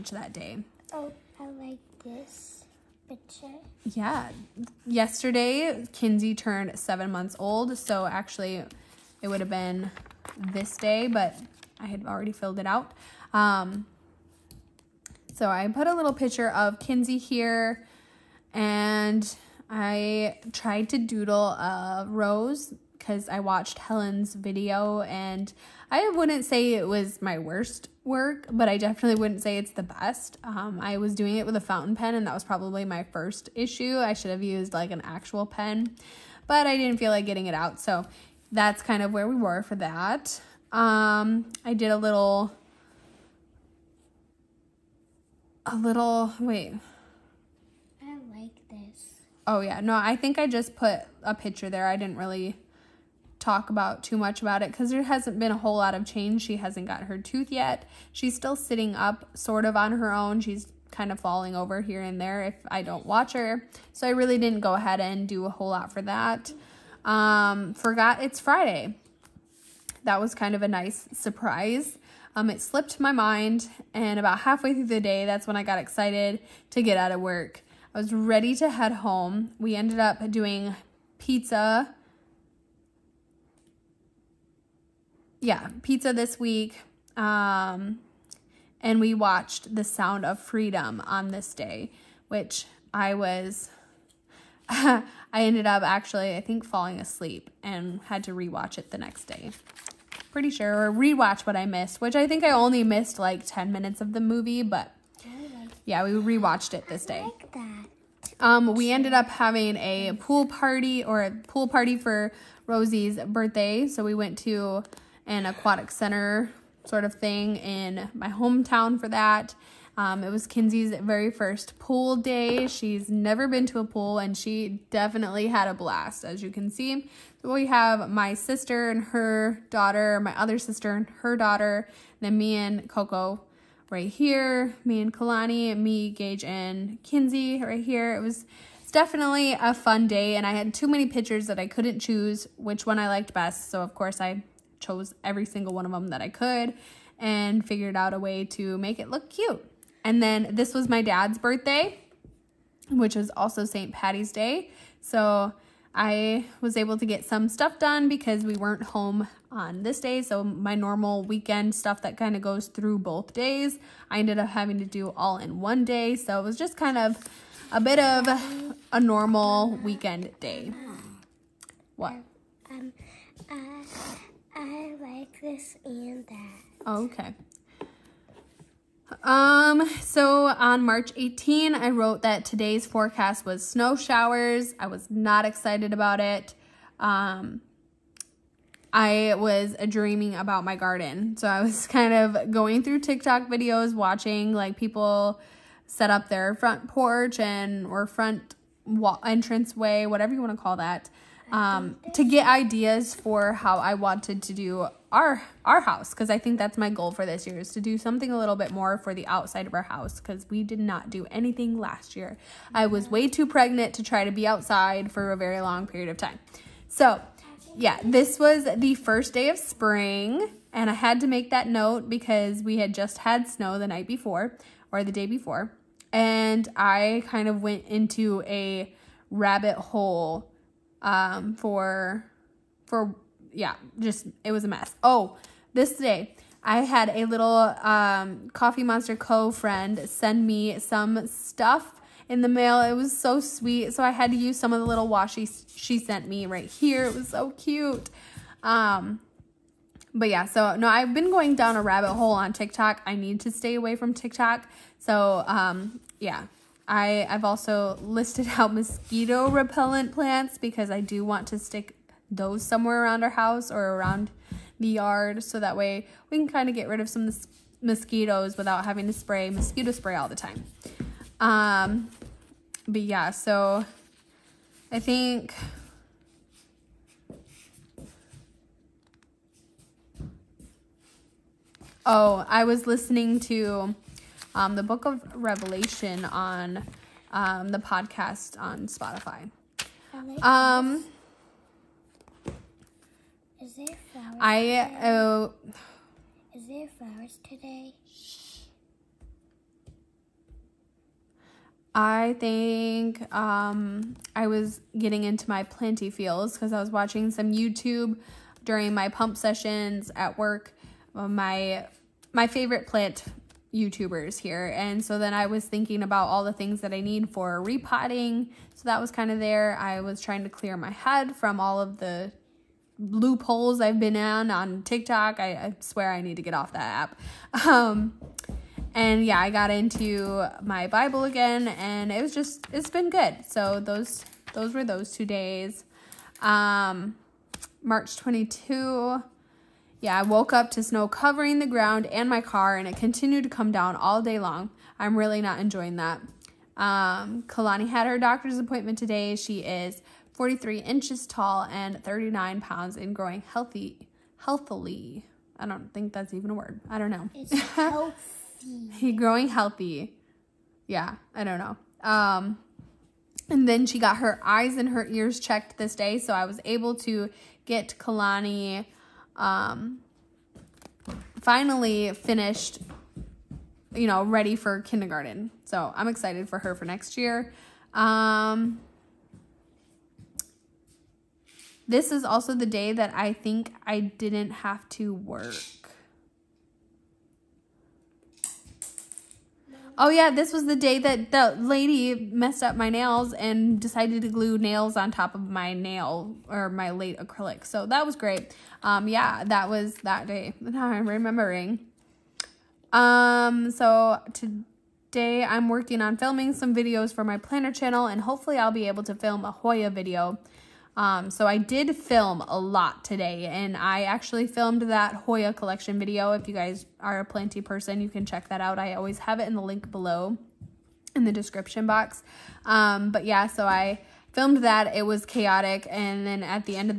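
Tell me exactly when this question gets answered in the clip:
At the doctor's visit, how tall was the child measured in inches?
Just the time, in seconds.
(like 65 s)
350 s.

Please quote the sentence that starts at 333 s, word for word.
So those those were those two days.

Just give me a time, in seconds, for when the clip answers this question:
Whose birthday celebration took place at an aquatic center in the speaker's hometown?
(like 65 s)
112 s.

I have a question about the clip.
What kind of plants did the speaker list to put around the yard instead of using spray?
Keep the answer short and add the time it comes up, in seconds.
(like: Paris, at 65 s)
Mosquito repellent plants, at 258 s.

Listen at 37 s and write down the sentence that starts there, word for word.
So that's kind of where we were for that.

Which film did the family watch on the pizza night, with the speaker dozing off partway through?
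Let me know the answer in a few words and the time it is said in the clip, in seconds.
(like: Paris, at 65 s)
The Sound of Freedom, at 89 s.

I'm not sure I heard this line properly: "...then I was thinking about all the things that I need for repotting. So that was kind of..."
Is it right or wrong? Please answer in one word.
right.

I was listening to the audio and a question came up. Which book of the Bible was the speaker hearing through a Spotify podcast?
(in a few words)
Revelation.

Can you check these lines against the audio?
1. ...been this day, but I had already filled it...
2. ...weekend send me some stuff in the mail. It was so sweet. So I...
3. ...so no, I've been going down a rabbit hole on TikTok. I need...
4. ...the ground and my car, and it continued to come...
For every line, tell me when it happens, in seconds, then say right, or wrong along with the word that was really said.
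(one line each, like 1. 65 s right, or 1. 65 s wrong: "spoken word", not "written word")
1. 9 s right
2. 239 s wrong: "friend", not "weekend"
3. 250 s right
4. 341 s right.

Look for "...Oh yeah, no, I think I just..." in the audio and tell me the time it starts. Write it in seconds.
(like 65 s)
49 s.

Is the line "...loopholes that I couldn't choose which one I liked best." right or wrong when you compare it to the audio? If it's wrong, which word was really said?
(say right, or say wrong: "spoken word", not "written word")
wrong: "pictures", not "loopholes".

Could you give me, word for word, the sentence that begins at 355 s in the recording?
I don't think that's even a word.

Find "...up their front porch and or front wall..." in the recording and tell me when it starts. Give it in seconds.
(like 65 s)
196 s.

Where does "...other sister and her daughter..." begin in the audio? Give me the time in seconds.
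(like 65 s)
130 s.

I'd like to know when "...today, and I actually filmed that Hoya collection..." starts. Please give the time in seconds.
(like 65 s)
413 s.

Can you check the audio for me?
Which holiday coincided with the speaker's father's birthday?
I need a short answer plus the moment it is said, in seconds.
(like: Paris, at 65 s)
St. Patty's Day, at 153 s.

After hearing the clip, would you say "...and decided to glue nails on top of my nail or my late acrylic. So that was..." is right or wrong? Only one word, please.
right.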